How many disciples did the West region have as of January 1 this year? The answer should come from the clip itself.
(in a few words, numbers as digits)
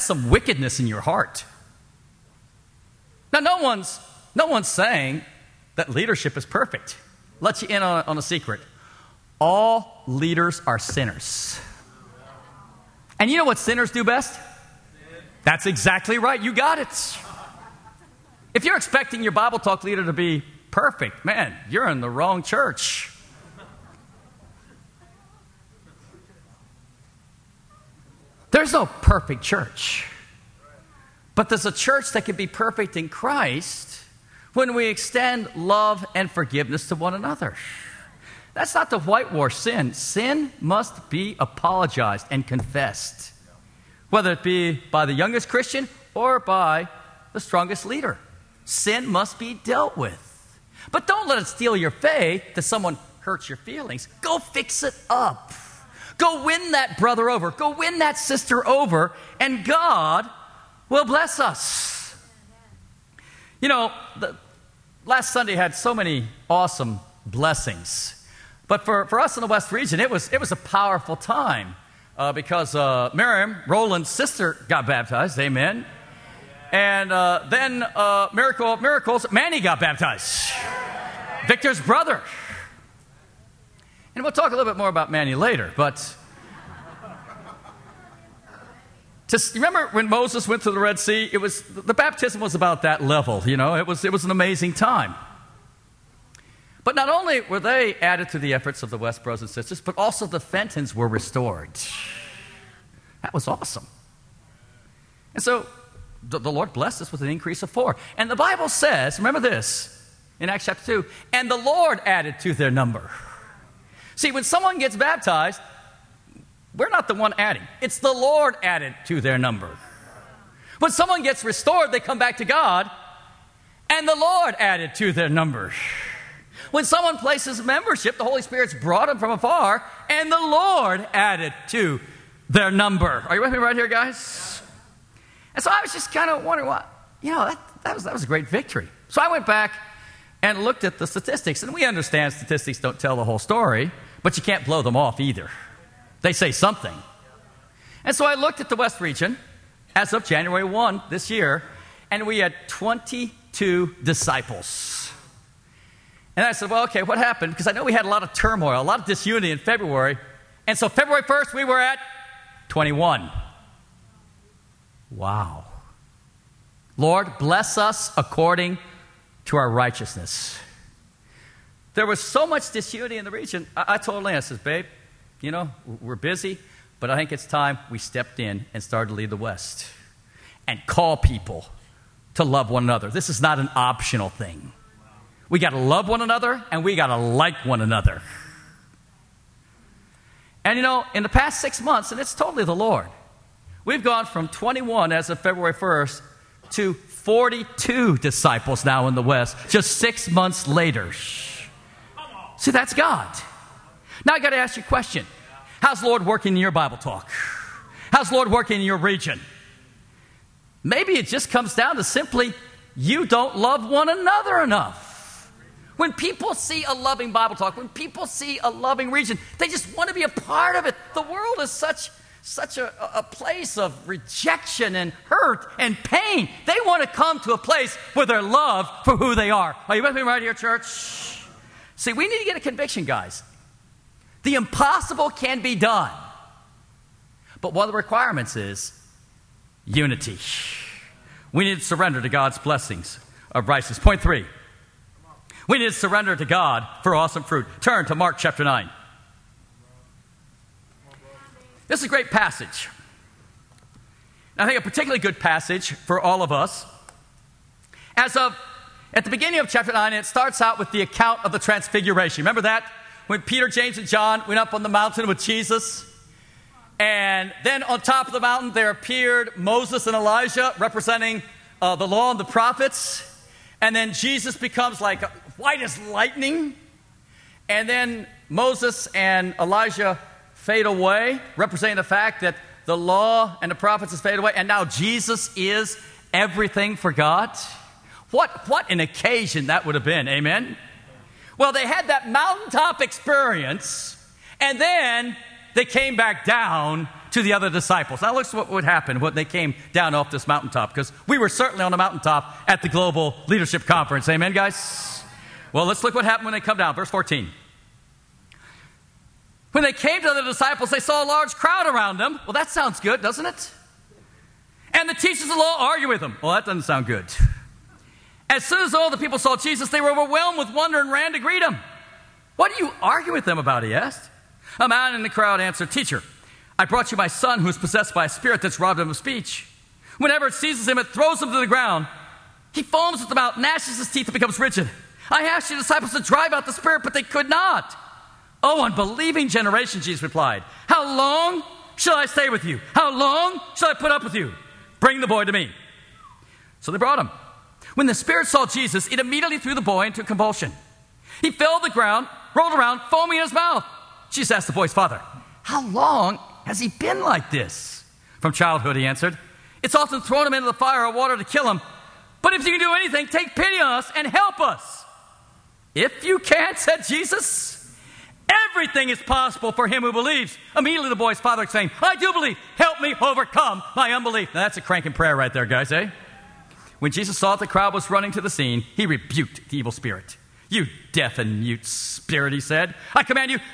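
22.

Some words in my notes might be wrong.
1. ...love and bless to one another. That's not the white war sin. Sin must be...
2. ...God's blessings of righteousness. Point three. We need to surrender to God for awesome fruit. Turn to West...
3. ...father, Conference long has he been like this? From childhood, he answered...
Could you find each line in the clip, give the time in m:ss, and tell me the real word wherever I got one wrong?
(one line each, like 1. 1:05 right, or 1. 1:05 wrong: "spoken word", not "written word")
1. 0:35 wrong: "forgiveness", not "bless"
2. 4:02 wrong: "Mark", not "West"
3. 5:54 wrong: "How", not "Conference".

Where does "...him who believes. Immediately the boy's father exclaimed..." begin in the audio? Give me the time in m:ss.
6:09.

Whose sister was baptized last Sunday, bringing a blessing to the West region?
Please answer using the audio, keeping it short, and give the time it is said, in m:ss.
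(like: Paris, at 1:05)
Roland, at 1:13.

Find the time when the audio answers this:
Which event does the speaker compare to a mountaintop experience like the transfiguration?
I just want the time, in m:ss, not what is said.
5:02.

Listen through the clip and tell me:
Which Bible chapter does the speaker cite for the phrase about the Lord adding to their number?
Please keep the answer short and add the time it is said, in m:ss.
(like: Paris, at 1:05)
Acts chapter 2, at 1:50.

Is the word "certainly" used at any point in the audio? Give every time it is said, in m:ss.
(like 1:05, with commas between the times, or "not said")
5:01.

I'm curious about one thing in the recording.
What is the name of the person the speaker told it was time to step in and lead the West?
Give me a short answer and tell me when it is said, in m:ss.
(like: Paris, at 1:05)
Lance, at 2:54.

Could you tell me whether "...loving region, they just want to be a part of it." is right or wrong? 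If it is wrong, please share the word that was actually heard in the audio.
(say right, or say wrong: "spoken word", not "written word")
right.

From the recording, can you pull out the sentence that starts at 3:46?
They want to come to a place where they're loved for who they are.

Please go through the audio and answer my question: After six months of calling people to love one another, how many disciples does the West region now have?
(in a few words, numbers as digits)
42.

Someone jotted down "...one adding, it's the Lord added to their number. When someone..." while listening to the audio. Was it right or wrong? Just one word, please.
right.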